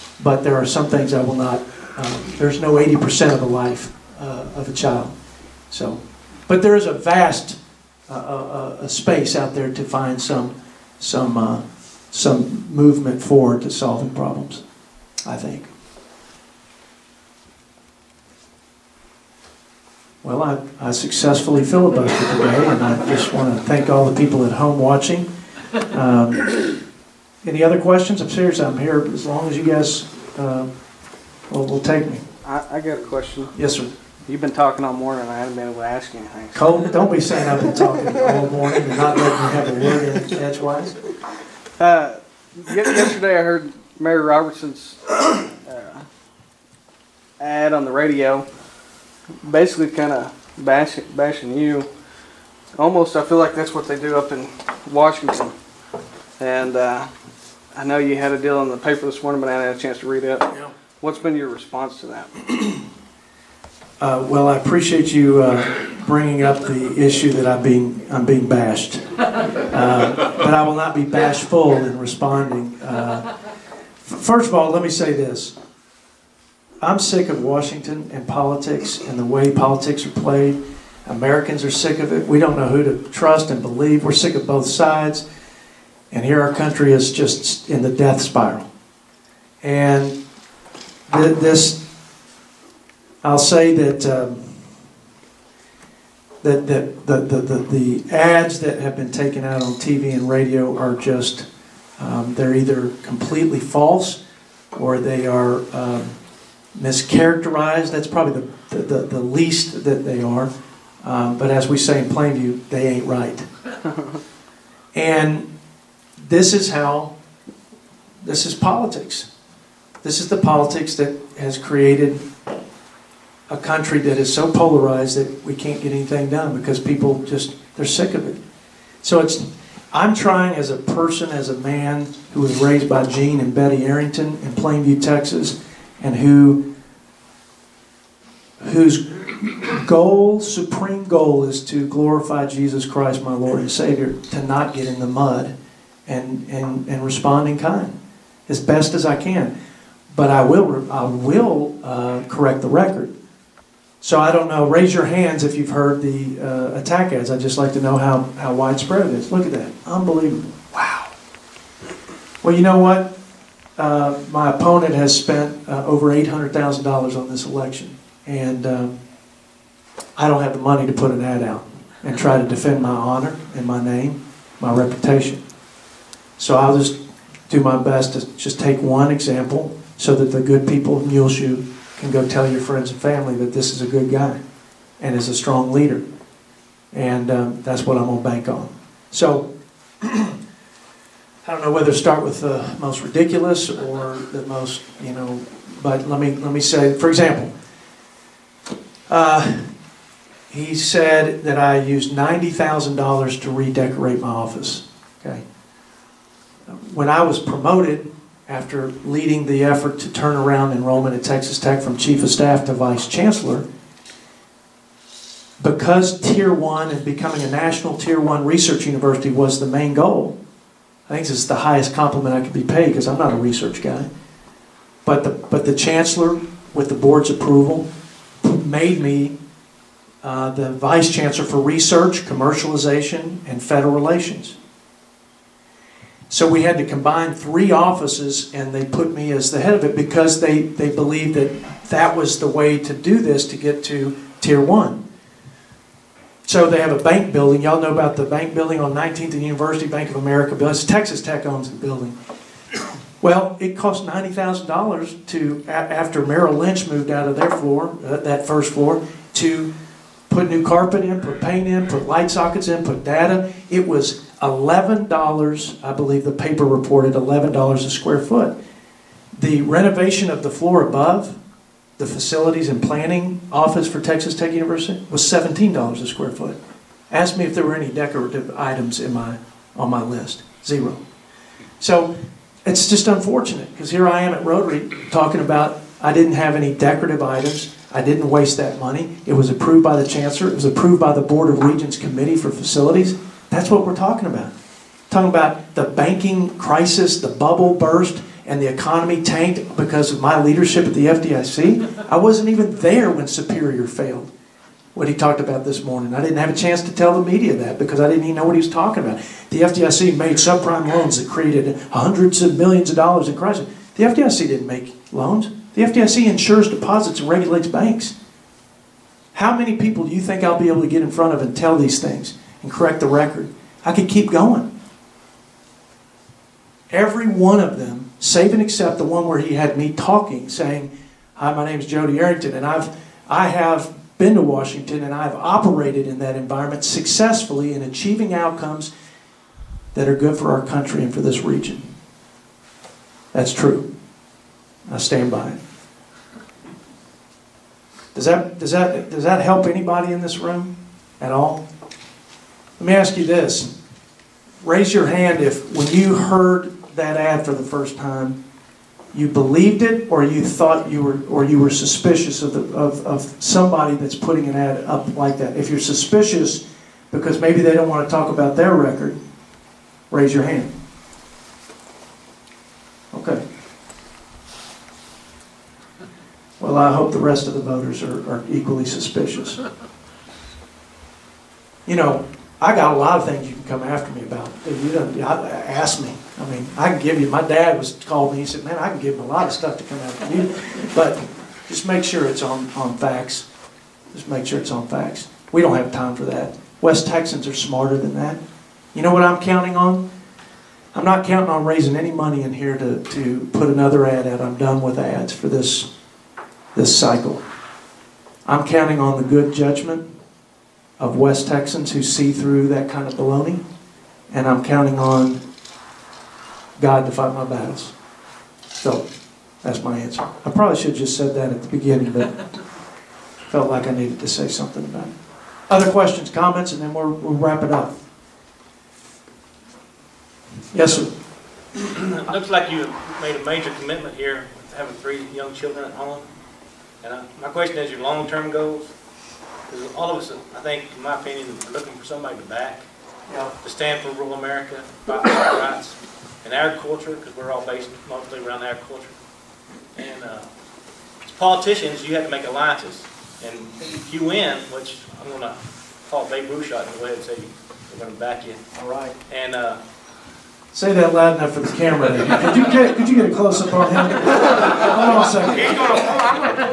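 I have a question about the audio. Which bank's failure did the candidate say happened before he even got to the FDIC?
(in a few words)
Superior.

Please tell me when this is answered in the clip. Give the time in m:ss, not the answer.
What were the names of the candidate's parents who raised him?
2:13.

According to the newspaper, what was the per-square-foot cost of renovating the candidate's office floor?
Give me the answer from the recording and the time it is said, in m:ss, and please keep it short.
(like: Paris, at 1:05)
$11, at 4:27.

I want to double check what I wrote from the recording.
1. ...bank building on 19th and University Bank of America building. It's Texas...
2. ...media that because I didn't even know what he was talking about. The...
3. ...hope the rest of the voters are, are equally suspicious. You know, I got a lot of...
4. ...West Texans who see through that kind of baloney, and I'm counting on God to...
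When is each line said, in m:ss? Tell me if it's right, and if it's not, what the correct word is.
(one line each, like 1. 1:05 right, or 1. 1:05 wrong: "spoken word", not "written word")
1. 4:08 right
2. 5:07 right
3. 6:16 right
4. 6:51 right.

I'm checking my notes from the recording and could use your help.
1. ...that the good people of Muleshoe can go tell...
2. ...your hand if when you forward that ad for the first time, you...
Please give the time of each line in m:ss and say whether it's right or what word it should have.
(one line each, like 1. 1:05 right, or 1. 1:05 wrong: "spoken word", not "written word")
1. 3:00 right
2. 5:54 wrong: "heard", not "forward".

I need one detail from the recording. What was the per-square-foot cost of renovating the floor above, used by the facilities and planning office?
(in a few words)
$17.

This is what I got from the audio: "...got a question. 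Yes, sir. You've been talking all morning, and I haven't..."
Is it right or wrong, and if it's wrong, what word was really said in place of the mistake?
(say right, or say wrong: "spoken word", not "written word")
right.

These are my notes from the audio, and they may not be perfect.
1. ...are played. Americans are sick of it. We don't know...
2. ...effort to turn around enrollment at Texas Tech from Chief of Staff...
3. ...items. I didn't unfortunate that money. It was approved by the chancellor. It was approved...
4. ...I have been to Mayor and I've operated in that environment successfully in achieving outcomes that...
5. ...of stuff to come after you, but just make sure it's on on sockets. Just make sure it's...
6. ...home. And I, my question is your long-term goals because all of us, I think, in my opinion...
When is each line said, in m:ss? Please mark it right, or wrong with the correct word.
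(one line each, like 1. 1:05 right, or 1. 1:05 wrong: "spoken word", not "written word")
1. 1:20 right
2. 3:29 right
3. 4:47 wrong: "waste", not "unfortunate"
4. 5:33 wrong: "Washington", not "Mayor"
5. 6:29 wrong: "facts", not "sockets"
6. 7:15 right.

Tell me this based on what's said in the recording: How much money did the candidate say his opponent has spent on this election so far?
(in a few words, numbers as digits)
over $800,000.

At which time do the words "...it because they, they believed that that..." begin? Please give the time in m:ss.
3:59.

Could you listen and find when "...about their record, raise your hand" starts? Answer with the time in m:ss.
6:08.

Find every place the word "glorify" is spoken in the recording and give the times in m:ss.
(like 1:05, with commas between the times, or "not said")
2:21.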